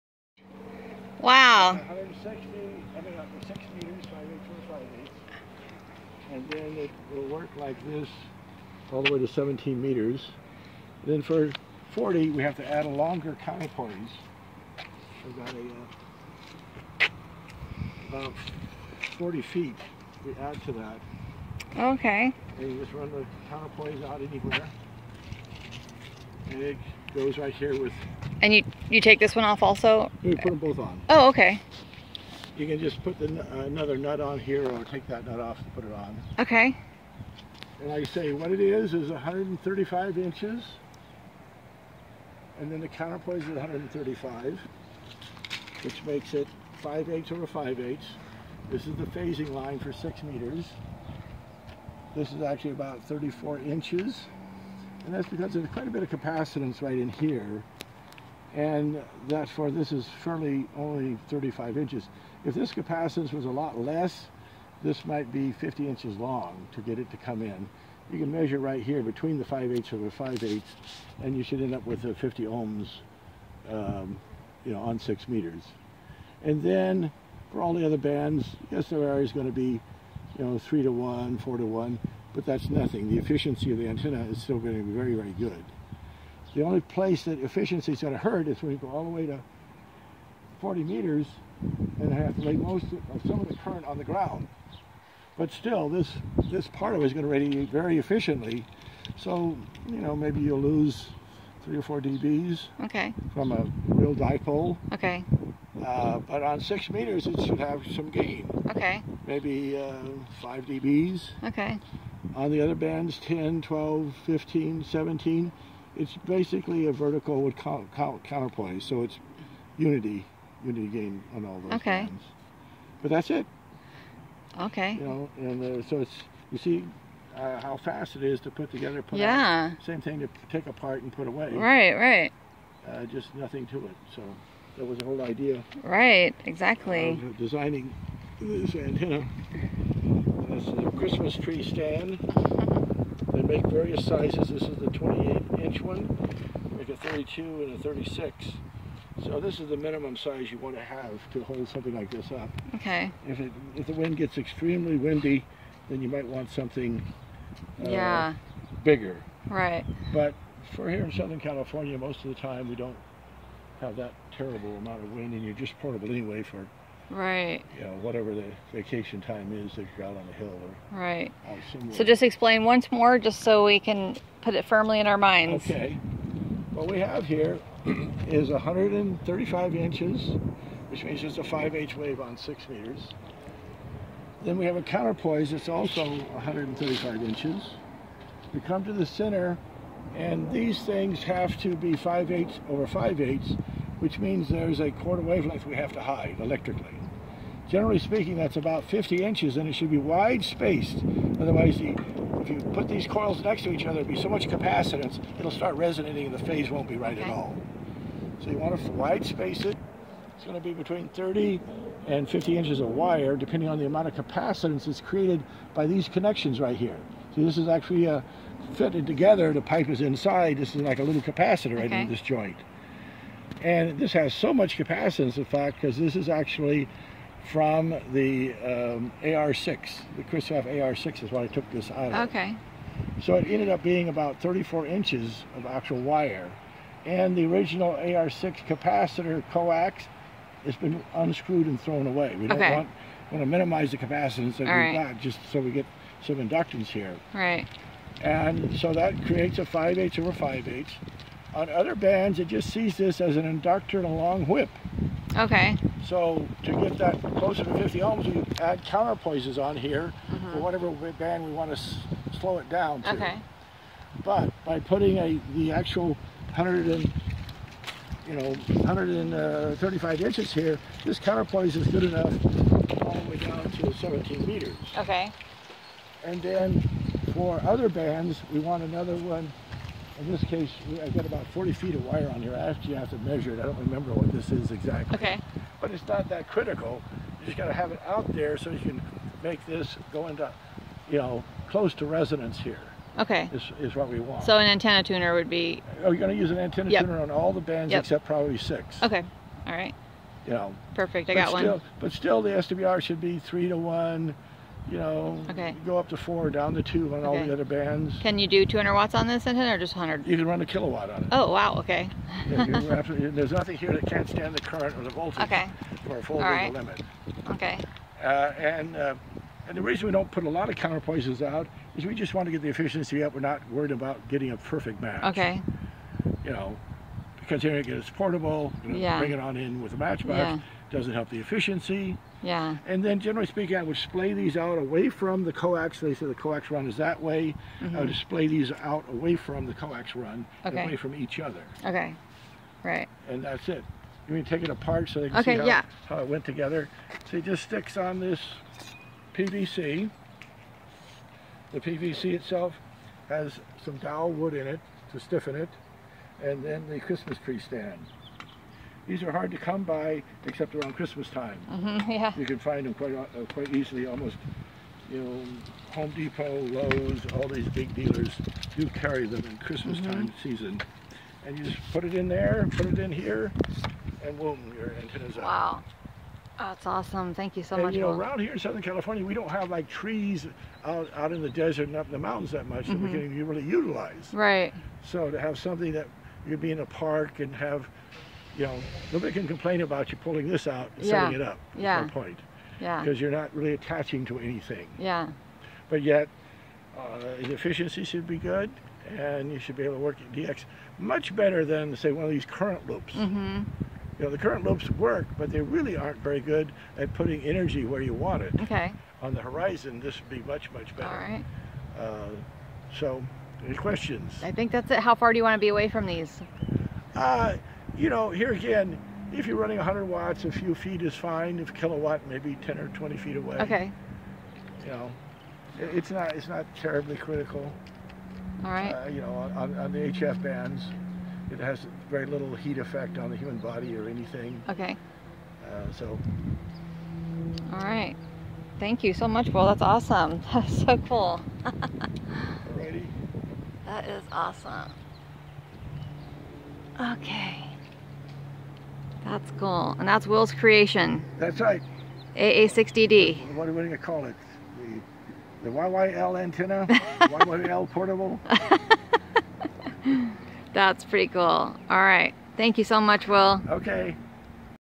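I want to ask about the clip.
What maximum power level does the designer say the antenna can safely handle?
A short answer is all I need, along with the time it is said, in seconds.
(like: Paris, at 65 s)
a kilowatt, at 310 s.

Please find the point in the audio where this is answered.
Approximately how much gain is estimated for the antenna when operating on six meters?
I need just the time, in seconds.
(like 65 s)
110 s.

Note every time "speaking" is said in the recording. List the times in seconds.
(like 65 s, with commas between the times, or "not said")
197 s, 333 s.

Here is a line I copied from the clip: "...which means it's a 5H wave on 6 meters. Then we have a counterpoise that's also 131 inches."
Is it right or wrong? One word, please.
wrong.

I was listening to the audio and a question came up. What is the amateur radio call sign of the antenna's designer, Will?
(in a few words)
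AA6DD.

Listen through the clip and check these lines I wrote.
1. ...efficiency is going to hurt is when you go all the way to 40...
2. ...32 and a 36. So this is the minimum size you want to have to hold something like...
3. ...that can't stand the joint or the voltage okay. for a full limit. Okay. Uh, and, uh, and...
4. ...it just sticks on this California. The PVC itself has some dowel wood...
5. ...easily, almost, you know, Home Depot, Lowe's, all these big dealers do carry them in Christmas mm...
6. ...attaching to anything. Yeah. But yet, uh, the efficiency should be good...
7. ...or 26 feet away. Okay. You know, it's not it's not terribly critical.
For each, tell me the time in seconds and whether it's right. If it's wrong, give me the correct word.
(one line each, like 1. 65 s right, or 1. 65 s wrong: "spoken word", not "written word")
1. 87 s right
2. 146 s right
3. 313 s wrong: "current", not "joint"
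4. 347 s wrong: "PVC", not "California"
5. 363 s right
6. 393 s right
7. 422 s wrong: "20", not "26".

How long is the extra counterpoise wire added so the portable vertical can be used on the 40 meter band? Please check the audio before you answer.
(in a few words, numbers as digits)
40 feet.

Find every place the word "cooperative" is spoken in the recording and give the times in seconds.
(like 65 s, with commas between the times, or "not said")
not said.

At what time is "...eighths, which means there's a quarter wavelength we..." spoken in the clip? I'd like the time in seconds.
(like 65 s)
193 s.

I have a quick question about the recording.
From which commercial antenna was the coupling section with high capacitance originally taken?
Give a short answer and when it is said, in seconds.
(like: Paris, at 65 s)
Kristoff AR-6, at 230 s.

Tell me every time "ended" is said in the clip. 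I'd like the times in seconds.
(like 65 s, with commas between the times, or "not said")
233 s.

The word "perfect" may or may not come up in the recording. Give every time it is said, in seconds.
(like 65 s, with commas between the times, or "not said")
300 s, 324 s.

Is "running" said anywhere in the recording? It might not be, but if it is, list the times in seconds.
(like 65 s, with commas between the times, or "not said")
419 s.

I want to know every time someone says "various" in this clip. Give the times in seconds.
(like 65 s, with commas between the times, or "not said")
143 s.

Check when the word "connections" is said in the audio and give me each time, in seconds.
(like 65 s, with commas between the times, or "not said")
216 s.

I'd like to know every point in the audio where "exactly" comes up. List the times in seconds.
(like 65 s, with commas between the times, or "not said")
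136 s, 284 s.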